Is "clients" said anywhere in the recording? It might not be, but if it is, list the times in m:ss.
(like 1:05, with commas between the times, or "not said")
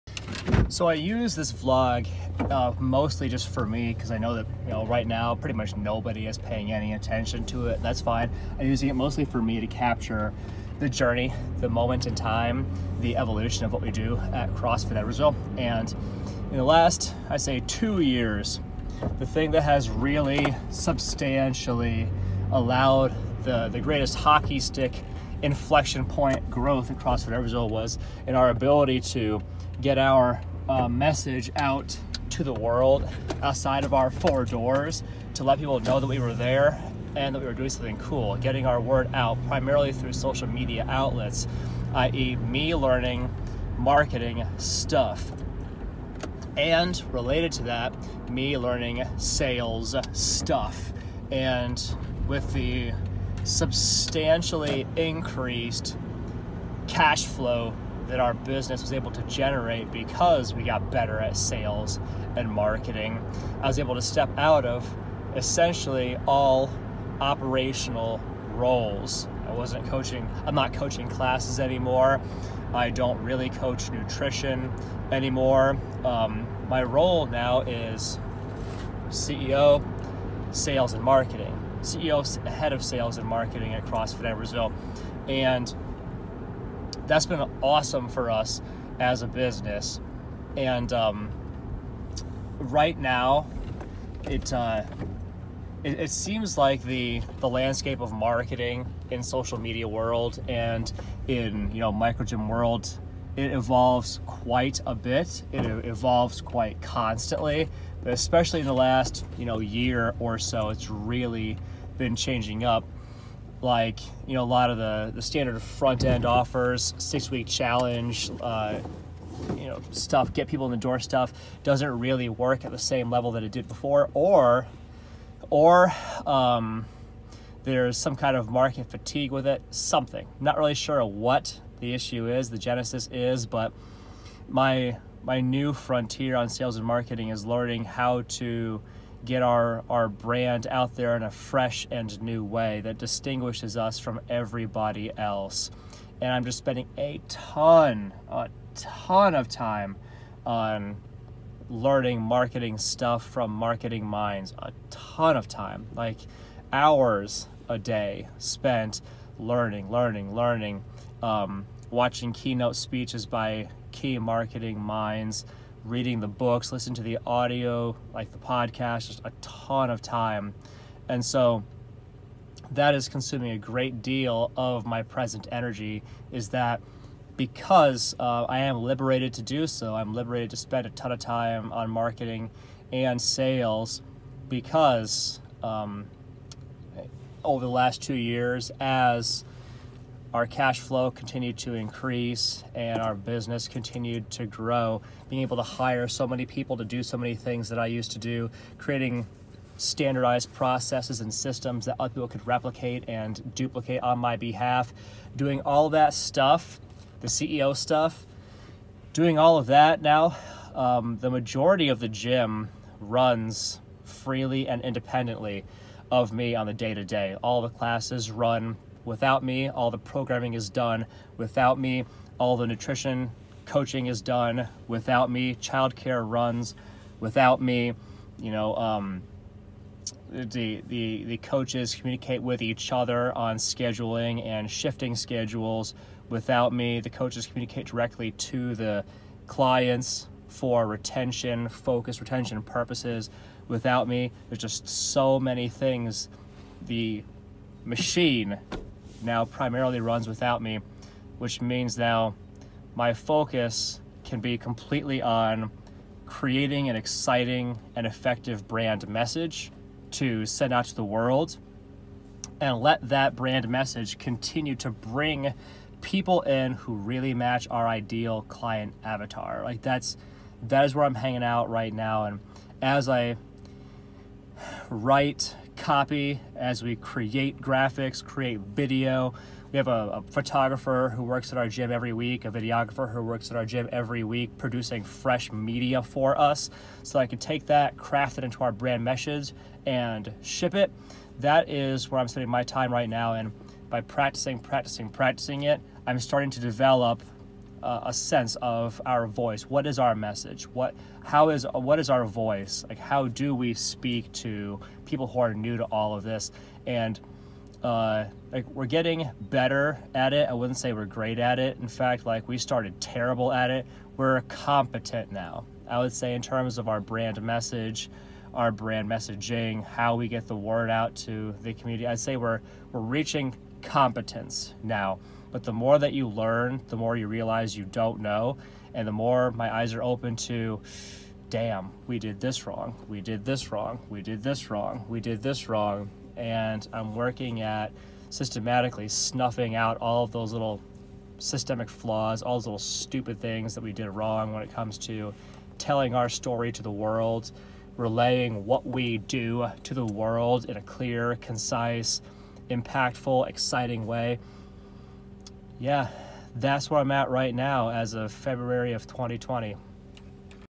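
3:59, 4:28.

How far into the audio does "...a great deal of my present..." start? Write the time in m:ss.
2:53.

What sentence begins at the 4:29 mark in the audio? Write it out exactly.
Like that's that is where I'm hanging out right now and as I write copy, as we create graphics, create video.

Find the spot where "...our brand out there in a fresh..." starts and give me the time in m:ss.
2:19.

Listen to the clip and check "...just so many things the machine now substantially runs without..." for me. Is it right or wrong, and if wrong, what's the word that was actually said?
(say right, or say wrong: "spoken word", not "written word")
wrong: "primarily", not "substantially".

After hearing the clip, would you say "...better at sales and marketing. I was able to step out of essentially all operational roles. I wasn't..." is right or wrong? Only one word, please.
right.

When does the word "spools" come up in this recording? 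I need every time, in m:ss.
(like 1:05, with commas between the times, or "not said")
not said.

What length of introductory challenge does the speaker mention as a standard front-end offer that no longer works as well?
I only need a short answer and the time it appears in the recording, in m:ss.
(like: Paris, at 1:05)
6 weeks, at 1:56.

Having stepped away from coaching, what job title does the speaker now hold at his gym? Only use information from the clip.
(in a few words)
CEO, head of sales and marketing.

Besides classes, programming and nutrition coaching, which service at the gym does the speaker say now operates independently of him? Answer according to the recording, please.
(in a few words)
Childcare.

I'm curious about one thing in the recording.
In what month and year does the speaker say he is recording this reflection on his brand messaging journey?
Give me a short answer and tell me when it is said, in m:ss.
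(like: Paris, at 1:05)
February 2020, at 5:58.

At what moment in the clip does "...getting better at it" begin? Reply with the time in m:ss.
5:08.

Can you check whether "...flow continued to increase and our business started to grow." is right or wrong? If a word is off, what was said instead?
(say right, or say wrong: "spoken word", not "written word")
wrong: "continued", not "started".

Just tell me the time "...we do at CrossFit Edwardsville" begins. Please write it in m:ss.
0:13.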